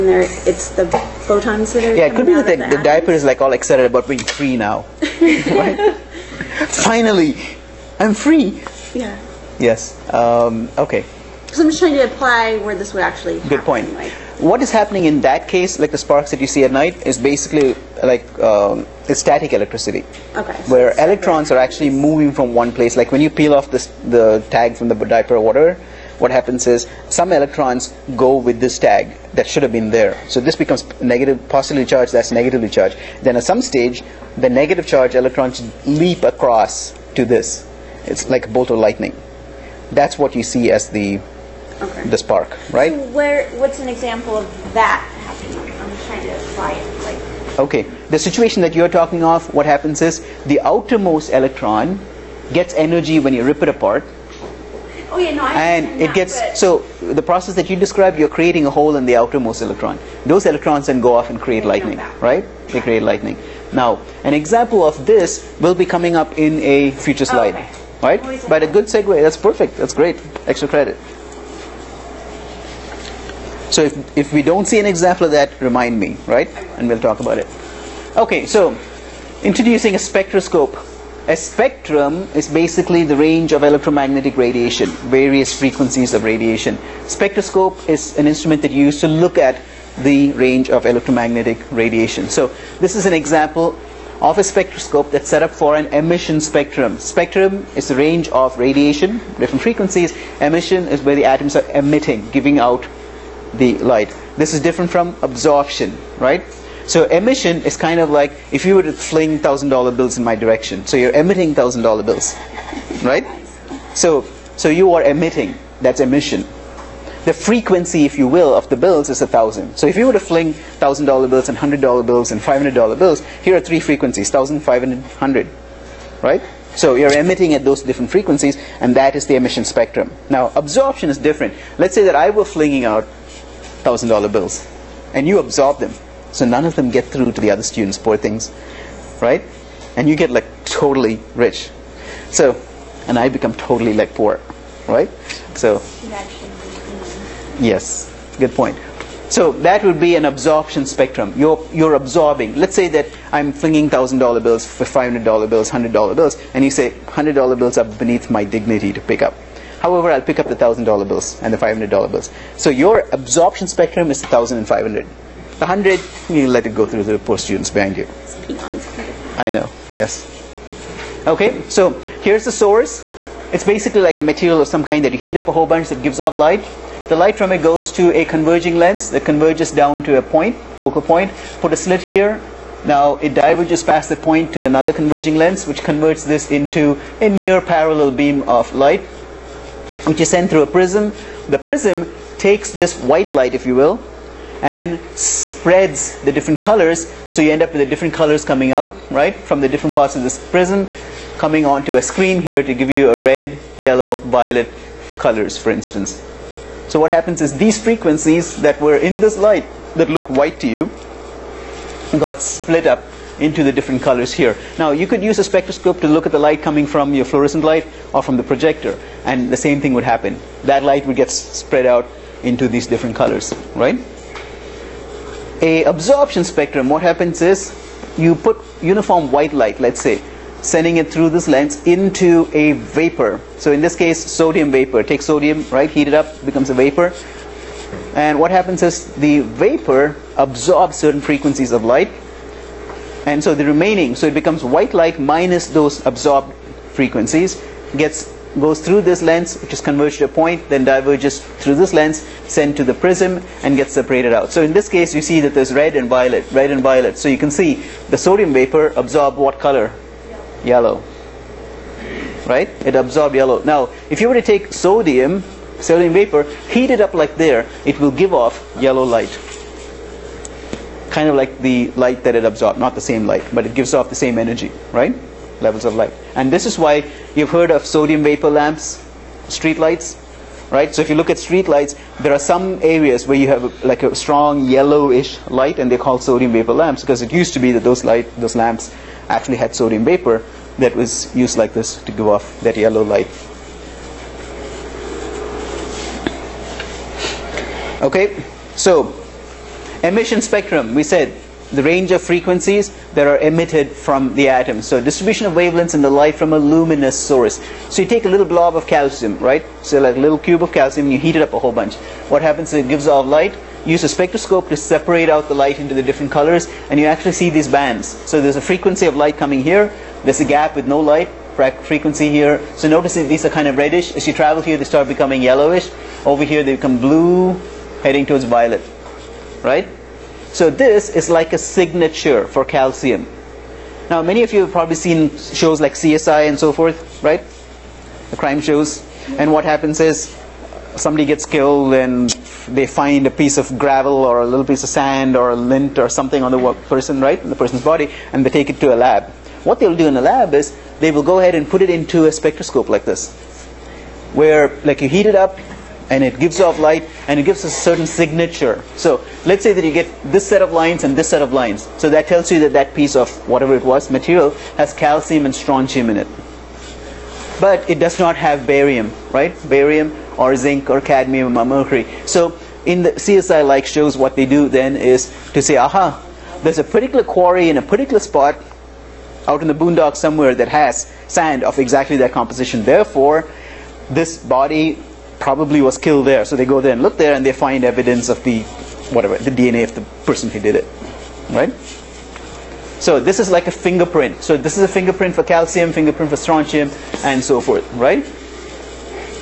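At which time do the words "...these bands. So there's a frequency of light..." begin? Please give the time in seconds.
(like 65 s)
317 s.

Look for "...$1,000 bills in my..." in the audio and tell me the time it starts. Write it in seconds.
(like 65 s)
109 s.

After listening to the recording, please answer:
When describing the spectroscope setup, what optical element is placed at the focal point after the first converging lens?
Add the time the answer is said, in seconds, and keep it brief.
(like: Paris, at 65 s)
A slit, at 181 s.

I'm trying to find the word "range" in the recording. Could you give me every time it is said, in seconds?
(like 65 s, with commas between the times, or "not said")
83 s, 90 s, 97 s, 301 s.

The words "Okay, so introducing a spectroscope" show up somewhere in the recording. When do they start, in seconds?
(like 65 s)
78 s.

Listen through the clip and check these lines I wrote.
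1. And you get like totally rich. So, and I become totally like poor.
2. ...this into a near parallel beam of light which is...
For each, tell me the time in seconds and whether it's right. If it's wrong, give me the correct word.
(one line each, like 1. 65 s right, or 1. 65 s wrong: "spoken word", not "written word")
1. 139 s right
2. 186 s right.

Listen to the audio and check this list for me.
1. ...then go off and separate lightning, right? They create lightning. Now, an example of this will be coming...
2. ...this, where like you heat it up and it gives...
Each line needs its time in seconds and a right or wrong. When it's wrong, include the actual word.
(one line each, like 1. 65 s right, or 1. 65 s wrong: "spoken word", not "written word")
1. 60 s wrong: "create", not "separate"
2. 353 s right.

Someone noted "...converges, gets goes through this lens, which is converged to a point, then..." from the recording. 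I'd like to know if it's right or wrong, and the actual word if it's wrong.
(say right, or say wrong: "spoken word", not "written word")
wrong: "frequencies", not "converges".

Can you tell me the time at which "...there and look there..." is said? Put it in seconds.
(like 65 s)
386 s.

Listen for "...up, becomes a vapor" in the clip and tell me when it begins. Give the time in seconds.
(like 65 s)
236 s.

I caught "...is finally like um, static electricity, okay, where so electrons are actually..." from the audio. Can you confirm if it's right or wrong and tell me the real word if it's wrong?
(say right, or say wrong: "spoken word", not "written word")
wrong: "basically", not "finally".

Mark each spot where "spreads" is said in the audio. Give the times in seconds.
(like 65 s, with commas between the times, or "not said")
195 s, 221 s.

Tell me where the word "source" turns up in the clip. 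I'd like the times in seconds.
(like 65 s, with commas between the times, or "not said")
172 s, 307 s.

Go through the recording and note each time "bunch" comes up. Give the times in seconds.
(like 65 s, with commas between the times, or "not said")
175 s, 311 s.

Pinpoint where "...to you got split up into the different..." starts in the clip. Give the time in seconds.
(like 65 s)
210 s.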